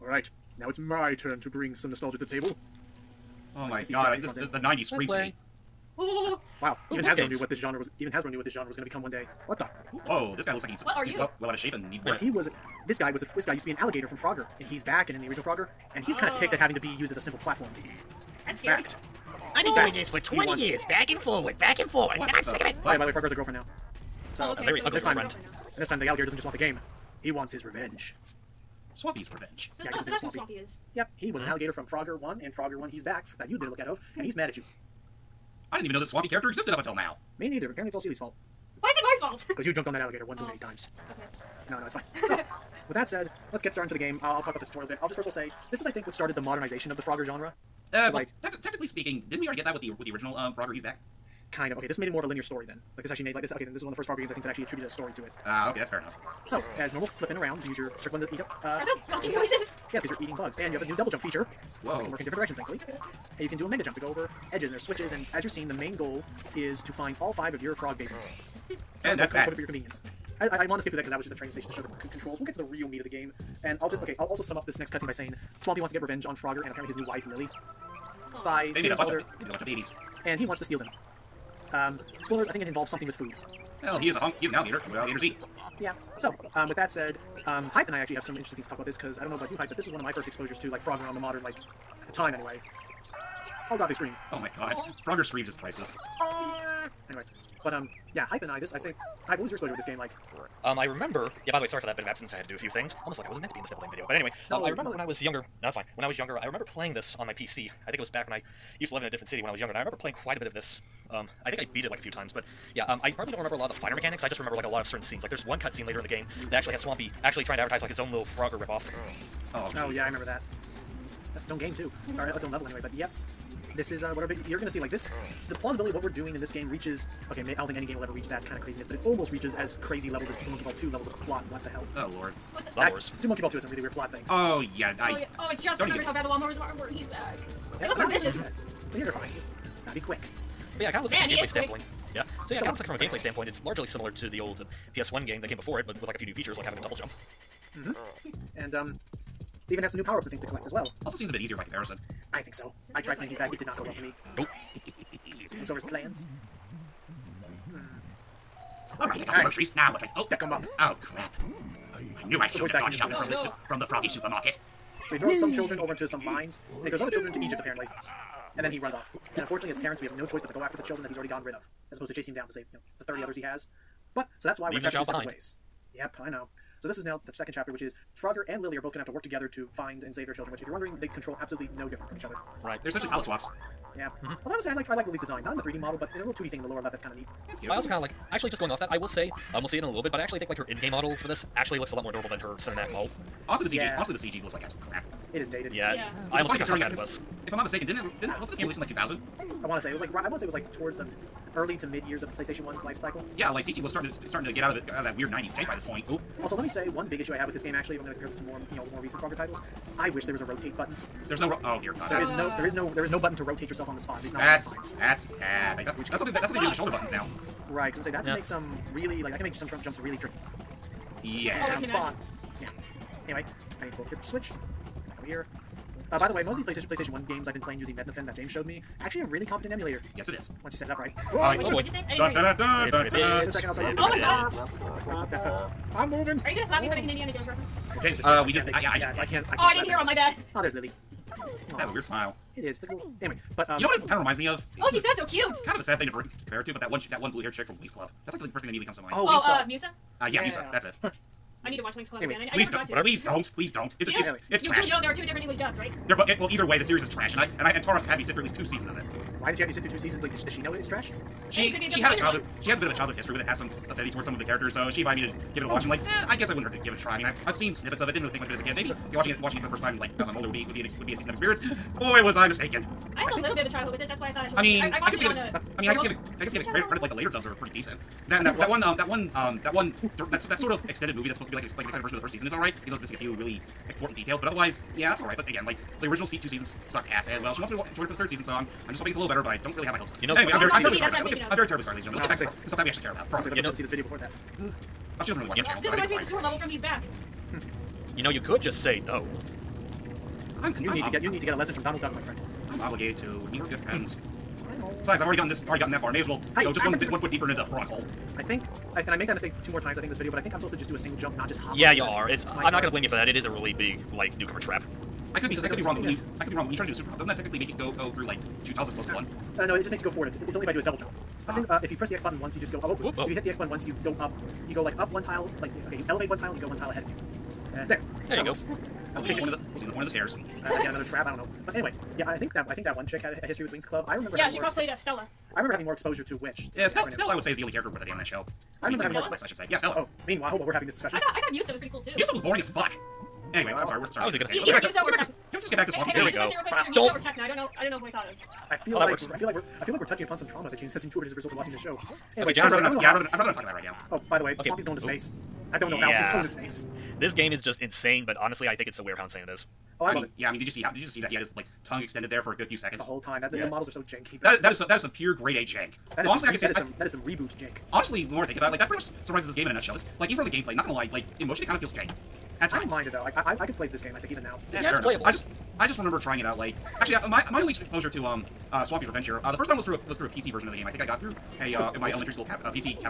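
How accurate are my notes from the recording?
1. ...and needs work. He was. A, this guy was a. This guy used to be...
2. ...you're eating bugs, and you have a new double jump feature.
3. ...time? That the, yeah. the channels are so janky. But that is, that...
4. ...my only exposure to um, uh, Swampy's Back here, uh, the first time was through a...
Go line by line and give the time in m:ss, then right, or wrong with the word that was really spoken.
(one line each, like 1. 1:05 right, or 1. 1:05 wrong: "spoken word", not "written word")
1. 0:11 right
2. 1:00 right
3. 6:03 wrong: "models", not "channels"
4. 6:17 wrong: "Revenge", not "Back".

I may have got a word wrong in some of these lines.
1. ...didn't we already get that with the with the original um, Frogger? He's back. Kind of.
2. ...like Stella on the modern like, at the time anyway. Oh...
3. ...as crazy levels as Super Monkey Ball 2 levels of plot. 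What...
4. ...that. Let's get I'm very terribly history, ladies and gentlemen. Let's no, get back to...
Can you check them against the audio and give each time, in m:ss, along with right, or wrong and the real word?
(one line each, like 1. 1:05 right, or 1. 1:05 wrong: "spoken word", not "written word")
1. 0:49 right
2. 1:30 wrong: "Frog", not "Stella"
3. 2:09 right
4. 4:51 wrong: "sorry", not "history".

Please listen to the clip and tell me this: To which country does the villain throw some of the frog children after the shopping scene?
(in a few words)
Egypt.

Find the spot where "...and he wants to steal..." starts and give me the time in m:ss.
1:20.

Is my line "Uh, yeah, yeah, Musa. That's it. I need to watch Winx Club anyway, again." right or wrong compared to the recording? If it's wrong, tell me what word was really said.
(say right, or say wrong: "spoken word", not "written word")
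right.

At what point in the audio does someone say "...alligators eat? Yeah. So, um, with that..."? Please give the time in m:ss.
1:24.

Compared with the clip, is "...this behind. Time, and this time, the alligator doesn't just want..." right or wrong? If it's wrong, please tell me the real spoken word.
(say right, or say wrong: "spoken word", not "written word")
wrong: "girlfriend", not "behind".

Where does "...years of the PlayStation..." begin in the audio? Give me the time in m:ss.
3:22.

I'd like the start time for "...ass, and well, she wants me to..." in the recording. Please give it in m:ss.
4:47.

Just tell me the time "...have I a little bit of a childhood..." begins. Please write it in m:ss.
4:33.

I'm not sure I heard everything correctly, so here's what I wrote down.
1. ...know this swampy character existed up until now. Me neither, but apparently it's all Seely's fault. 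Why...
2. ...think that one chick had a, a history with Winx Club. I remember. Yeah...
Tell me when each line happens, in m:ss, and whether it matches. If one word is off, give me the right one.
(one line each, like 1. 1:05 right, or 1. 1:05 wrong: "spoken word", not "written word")
1. 0:35 right
2. 5:32 right.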